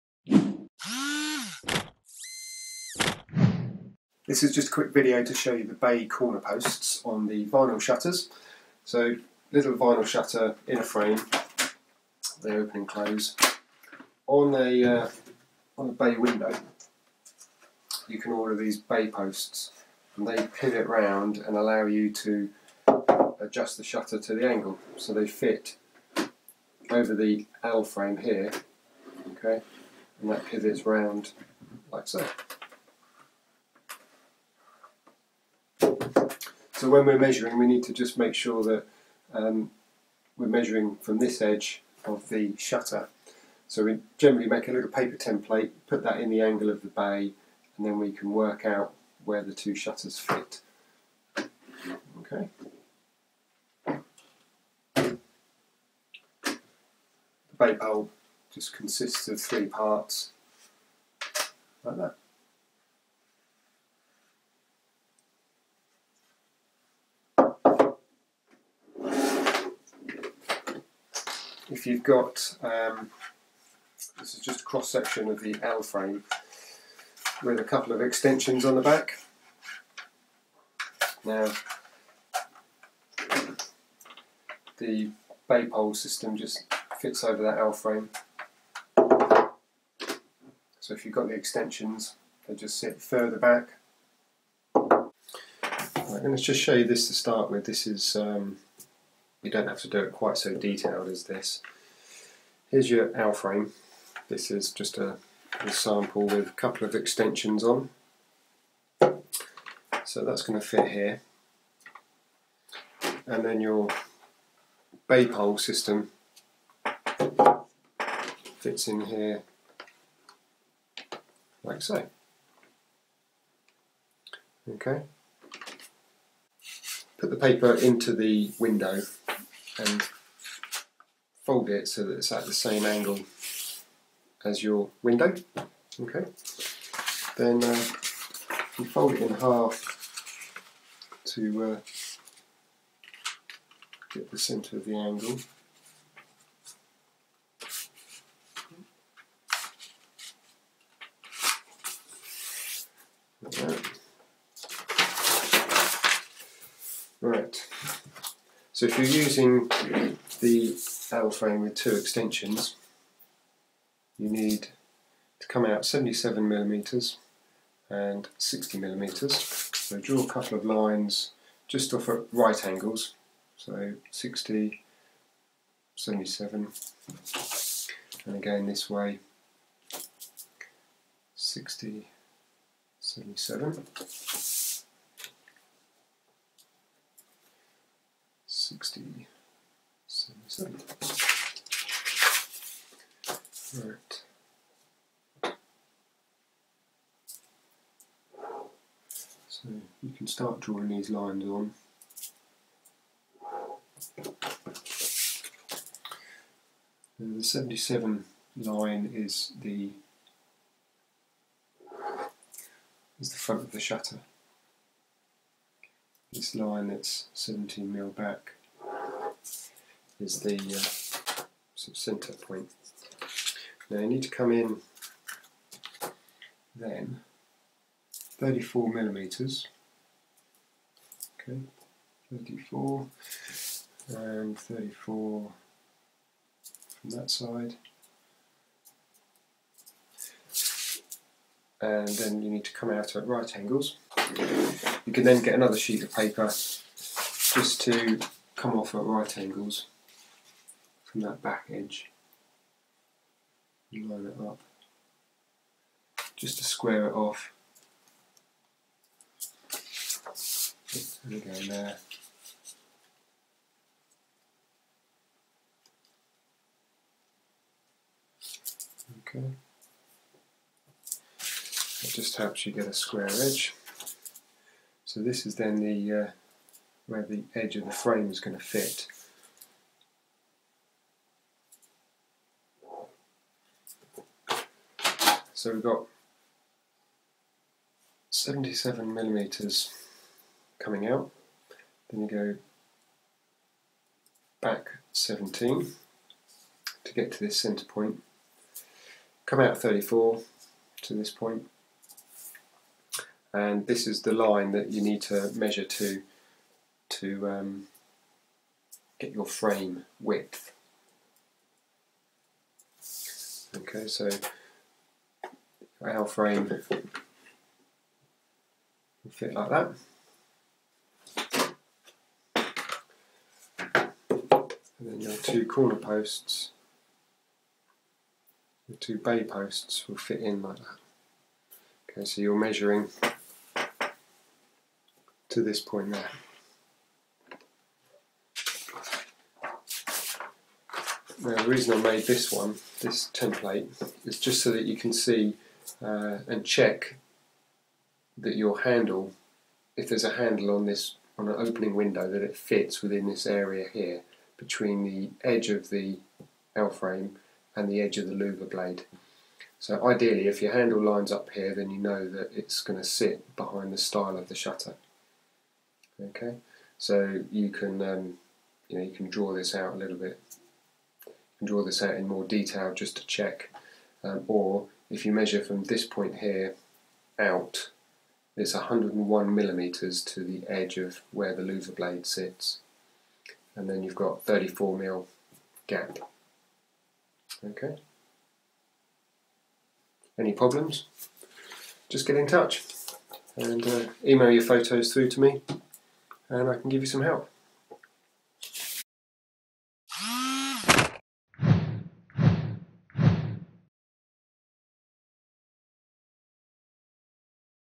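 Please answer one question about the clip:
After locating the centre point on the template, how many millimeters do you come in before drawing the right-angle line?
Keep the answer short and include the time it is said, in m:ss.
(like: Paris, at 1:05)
34, at 3:48.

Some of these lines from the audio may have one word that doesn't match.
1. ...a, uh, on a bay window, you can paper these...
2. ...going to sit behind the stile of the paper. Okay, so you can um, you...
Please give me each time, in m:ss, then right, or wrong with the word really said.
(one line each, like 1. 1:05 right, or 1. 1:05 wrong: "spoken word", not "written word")
1. 0:14 wrong: "order", not "paper"
2. 6:02 wrong: "shutter", not "paper".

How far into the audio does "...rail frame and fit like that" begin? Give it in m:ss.
5:16.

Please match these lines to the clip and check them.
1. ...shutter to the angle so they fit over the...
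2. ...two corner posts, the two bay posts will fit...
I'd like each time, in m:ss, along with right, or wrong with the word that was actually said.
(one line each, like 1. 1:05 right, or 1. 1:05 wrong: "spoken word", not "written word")
1. 0:23 right
2. 5:25 right.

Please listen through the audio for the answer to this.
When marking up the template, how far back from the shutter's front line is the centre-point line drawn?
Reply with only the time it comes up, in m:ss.
3:37.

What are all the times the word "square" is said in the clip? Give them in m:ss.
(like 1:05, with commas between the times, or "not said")
4:16, 4:32.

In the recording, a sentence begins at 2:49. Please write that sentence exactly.
So draw a couple of lines just off at right angles.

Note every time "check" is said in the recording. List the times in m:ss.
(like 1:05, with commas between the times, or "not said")
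5:46, 6:13.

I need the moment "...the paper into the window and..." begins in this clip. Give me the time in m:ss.
2:07.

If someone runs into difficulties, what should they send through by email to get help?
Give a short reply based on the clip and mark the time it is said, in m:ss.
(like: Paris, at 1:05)
Photos, at 6:34.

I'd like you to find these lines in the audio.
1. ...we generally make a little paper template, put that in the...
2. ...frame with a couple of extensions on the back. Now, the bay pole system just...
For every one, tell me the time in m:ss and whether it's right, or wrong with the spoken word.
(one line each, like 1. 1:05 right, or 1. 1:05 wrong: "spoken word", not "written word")
1. 0:43 right
2. 1:15 right.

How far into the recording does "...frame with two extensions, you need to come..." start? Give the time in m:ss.
2:41.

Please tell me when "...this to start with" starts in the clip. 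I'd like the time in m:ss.
1:36.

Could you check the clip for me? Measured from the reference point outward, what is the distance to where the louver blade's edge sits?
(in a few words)
101 millimeters.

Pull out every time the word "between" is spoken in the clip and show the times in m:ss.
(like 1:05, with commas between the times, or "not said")
5:54.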